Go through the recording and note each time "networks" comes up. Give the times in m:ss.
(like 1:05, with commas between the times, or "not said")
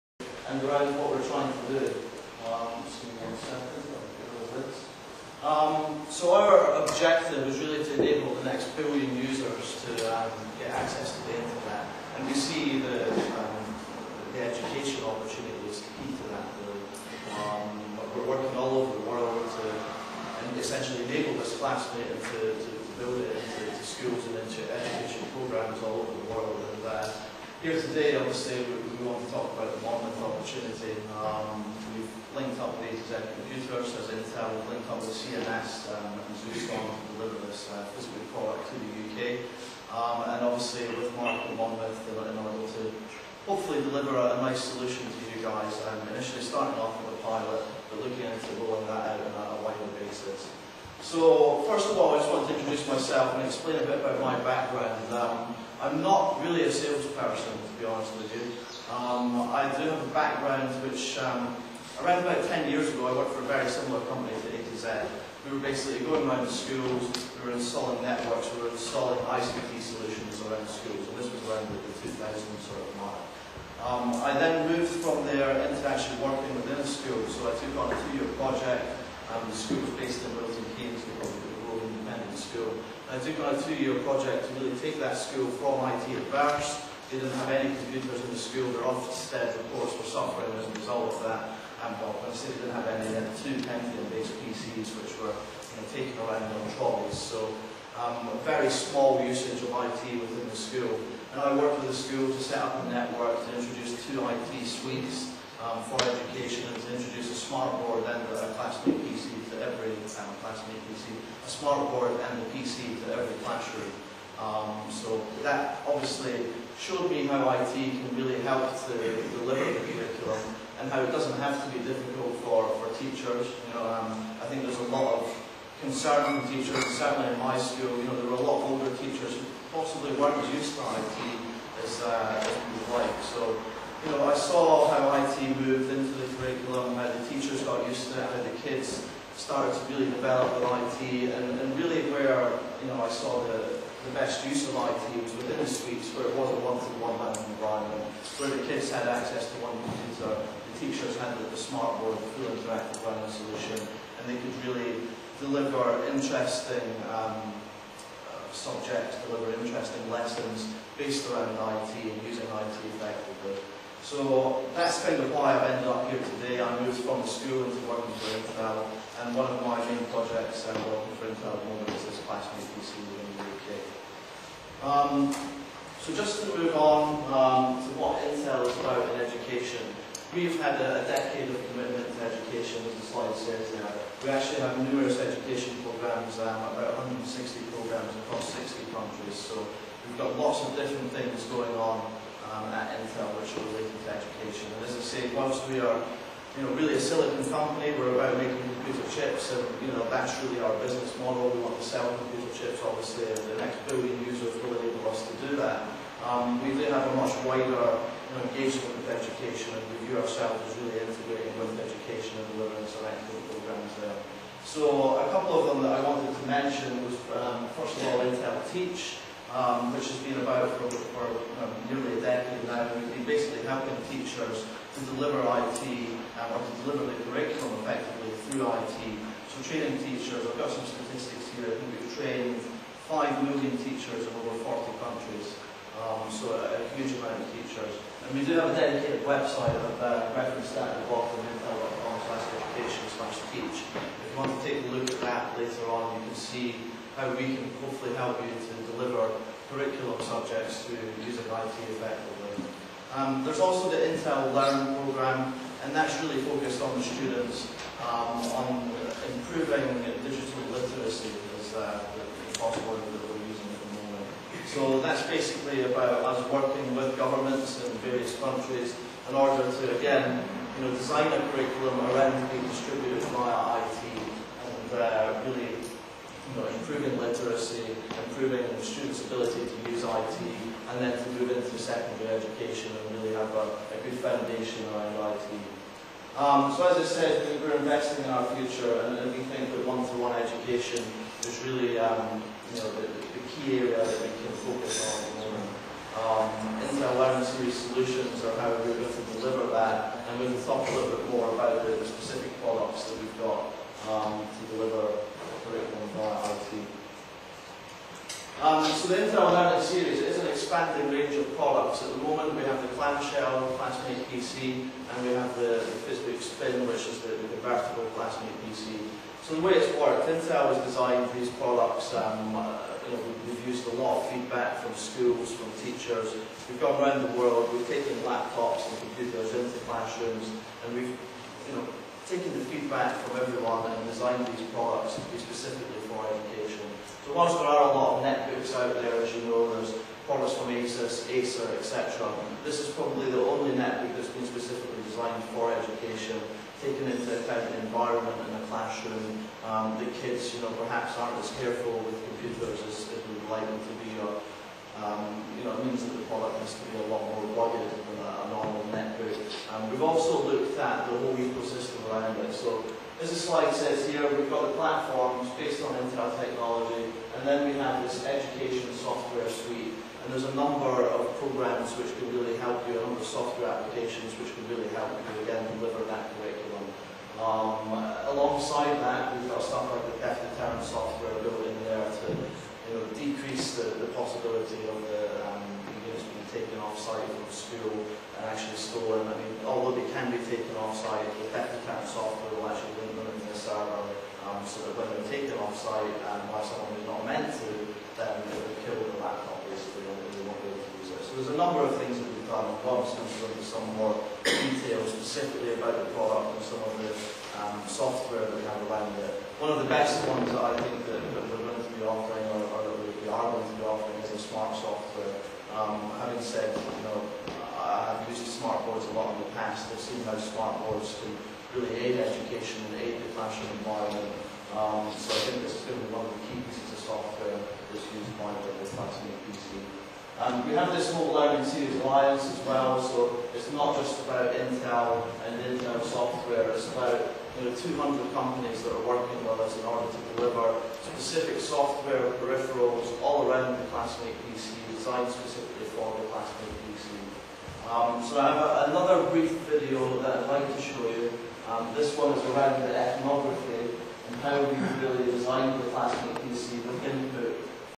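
1:08, 1:42.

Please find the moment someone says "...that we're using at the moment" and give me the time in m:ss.
4:23.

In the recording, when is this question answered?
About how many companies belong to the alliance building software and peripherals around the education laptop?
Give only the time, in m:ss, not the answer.
7:17.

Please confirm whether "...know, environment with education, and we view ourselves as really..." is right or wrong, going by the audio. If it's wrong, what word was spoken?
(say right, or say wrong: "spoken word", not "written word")
wrong: "engagement", not "environment".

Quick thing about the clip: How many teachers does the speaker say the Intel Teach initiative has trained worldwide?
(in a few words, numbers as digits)
5 million.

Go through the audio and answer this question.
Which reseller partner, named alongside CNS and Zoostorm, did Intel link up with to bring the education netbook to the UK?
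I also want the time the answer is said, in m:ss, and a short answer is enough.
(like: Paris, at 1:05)
A2Z Computers, at 0:32.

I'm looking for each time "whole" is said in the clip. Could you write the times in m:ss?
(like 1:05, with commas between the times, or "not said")
6:01, 7:11.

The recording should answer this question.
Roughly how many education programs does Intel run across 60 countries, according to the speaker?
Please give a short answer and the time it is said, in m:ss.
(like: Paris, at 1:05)
160, at 3:07.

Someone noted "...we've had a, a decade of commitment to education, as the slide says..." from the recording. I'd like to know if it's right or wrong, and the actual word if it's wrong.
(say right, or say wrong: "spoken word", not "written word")
right.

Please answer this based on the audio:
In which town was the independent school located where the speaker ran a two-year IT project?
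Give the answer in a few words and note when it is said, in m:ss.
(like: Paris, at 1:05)
Milton Keynes, at 1:20.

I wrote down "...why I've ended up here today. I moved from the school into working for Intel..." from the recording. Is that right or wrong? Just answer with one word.
right.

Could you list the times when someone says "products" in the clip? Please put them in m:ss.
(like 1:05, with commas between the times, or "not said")
0:38, 5:02, 5:11, 5:21, 5:34, 5:40, 5:56, 6:46.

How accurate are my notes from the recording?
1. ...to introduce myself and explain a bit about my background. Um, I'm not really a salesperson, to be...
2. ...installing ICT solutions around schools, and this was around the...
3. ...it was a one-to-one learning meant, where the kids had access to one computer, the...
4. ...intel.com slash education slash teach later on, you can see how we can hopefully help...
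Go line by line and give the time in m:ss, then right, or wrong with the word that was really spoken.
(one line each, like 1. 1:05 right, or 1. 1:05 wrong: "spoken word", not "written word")
1. 0:52 right
2. 1:08 right
3. 2:26 wrong: "environment", not "meant"
4. 4:01 right.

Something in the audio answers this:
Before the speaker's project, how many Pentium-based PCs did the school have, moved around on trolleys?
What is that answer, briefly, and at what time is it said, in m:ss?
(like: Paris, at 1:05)
2, at 1:33.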